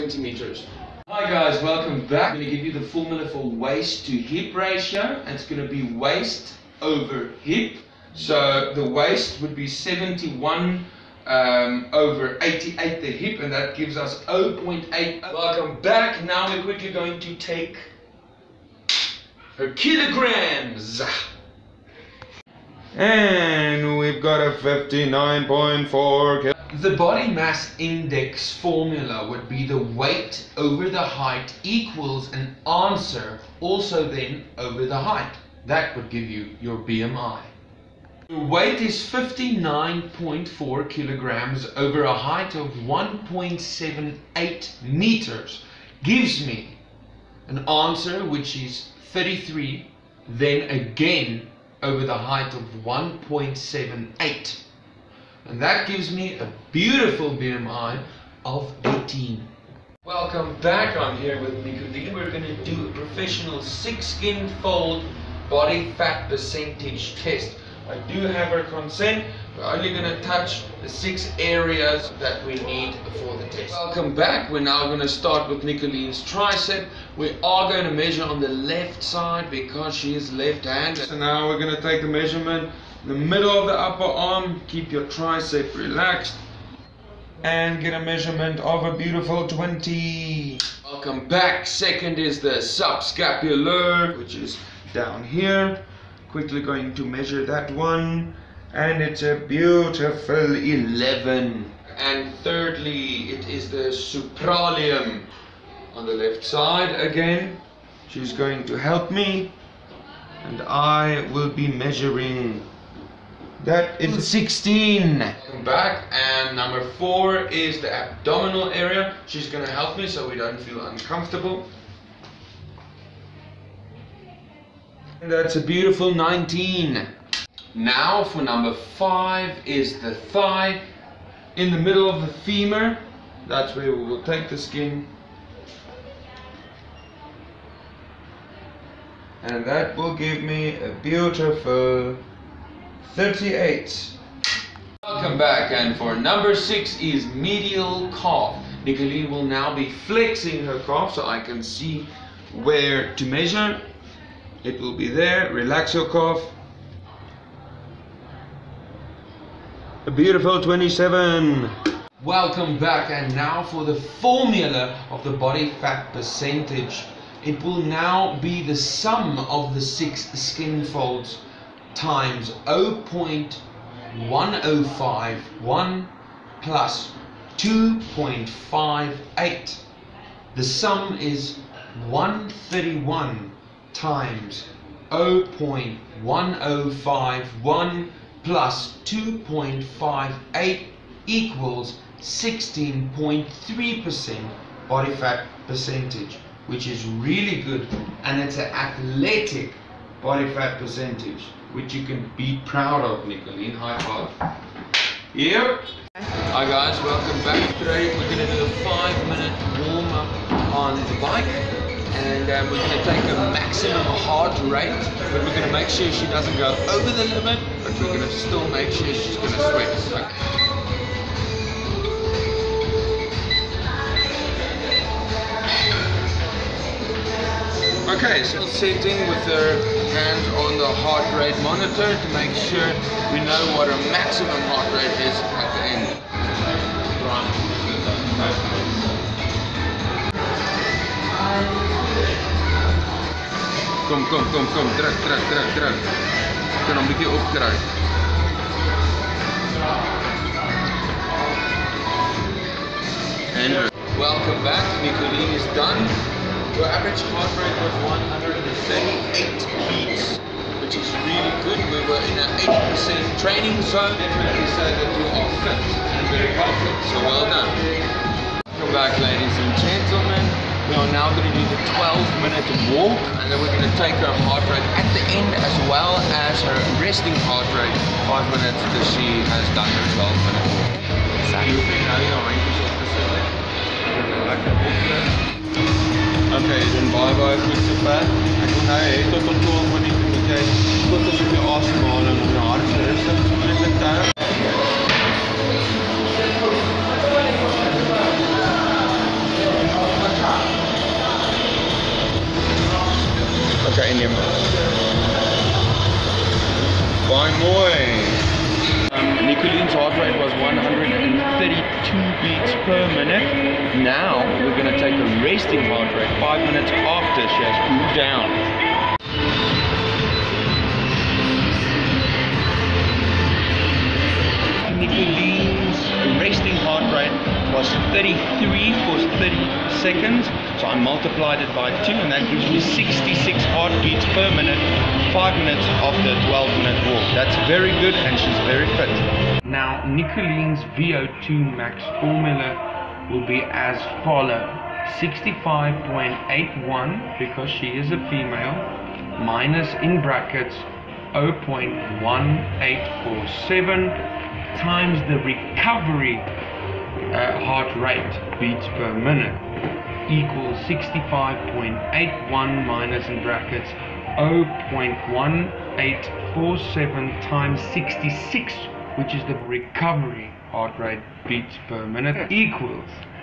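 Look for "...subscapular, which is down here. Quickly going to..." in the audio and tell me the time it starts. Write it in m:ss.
1:32.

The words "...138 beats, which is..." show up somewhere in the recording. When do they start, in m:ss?
4:18.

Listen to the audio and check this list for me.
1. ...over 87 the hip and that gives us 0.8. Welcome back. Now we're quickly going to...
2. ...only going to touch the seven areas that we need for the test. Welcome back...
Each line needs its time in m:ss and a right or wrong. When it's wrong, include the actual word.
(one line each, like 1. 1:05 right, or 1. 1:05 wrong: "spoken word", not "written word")
1. 0:11 wrong: "88", not "87"
2. 1:09 wrong: "six", not "seven".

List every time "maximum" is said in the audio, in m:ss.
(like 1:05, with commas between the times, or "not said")
3:33, 3:54.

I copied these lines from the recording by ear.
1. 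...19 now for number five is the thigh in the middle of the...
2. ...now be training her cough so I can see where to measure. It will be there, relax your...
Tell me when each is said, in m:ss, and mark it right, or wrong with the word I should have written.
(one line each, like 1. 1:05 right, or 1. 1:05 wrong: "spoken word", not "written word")
1. 2:06 right
2. 2:29 wrong: "flexing", not "training".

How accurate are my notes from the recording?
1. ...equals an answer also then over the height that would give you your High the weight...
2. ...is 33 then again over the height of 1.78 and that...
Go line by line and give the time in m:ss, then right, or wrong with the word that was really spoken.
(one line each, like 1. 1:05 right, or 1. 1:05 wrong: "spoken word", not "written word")
1. 0:31 wrong: "BMI", not "High"
2. 0:48 right.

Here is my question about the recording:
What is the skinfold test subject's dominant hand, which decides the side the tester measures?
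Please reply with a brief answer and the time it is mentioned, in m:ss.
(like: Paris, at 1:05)
left-handed, at 1:20.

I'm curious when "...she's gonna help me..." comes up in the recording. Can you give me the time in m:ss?
1:59.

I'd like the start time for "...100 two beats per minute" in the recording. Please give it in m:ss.
5:10.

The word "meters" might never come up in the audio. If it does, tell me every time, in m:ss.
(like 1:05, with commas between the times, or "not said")
0:44.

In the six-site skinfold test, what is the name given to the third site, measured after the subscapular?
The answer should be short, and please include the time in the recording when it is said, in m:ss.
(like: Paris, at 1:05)
supralium, at 1:43.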